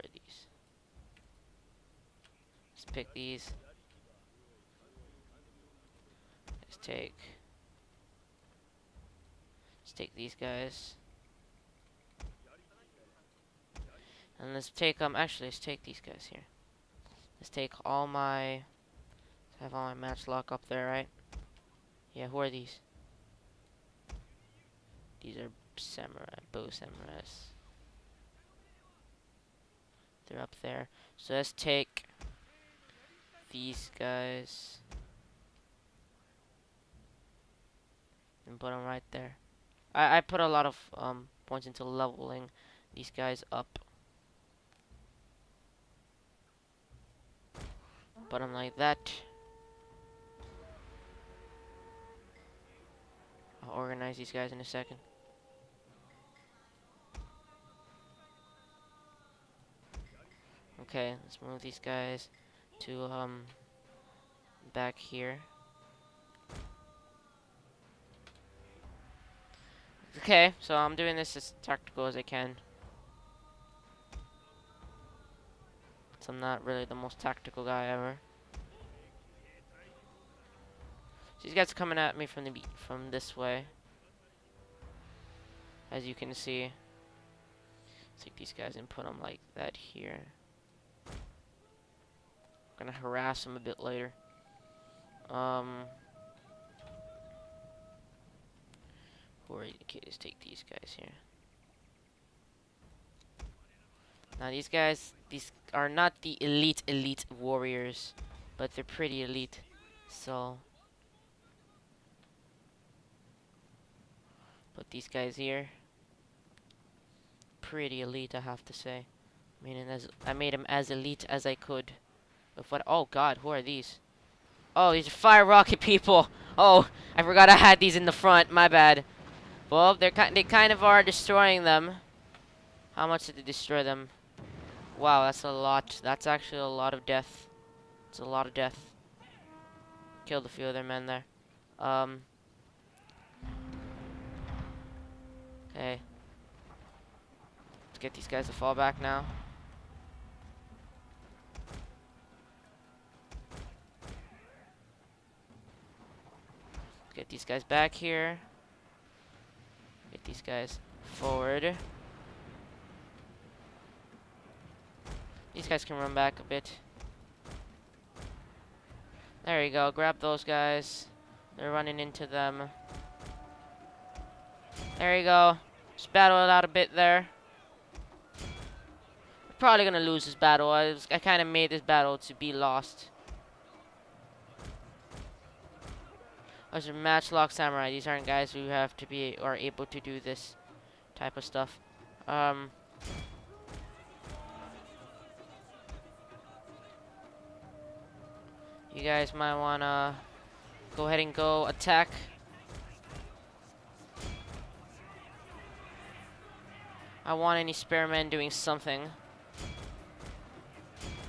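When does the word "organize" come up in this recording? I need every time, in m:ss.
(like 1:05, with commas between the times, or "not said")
0:53.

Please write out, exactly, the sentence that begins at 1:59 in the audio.
I mean as I made them as elite as I could.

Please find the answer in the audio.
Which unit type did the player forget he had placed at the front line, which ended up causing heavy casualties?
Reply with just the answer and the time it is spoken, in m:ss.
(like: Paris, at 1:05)
Fire rocket, at 2:05.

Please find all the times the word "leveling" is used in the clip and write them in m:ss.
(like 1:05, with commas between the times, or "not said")
0:41.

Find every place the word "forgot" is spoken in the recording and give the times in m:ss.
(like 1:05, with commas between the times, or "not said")
2:07.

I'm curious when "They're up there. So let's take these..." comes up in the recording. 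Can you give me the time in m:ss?
0:30.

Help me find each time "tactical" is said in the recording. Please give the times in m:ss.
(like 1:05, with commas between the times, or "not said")
1:11, 1:17.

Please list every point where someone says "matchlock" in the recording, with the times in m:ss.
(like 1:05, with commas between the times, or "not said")
0:19, 3:06.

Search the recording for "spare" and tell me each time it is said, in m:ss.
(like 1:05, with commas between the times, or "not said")
3:27.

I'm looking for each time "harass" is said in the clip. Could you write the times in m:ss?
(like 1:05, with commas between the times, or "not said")
1:32.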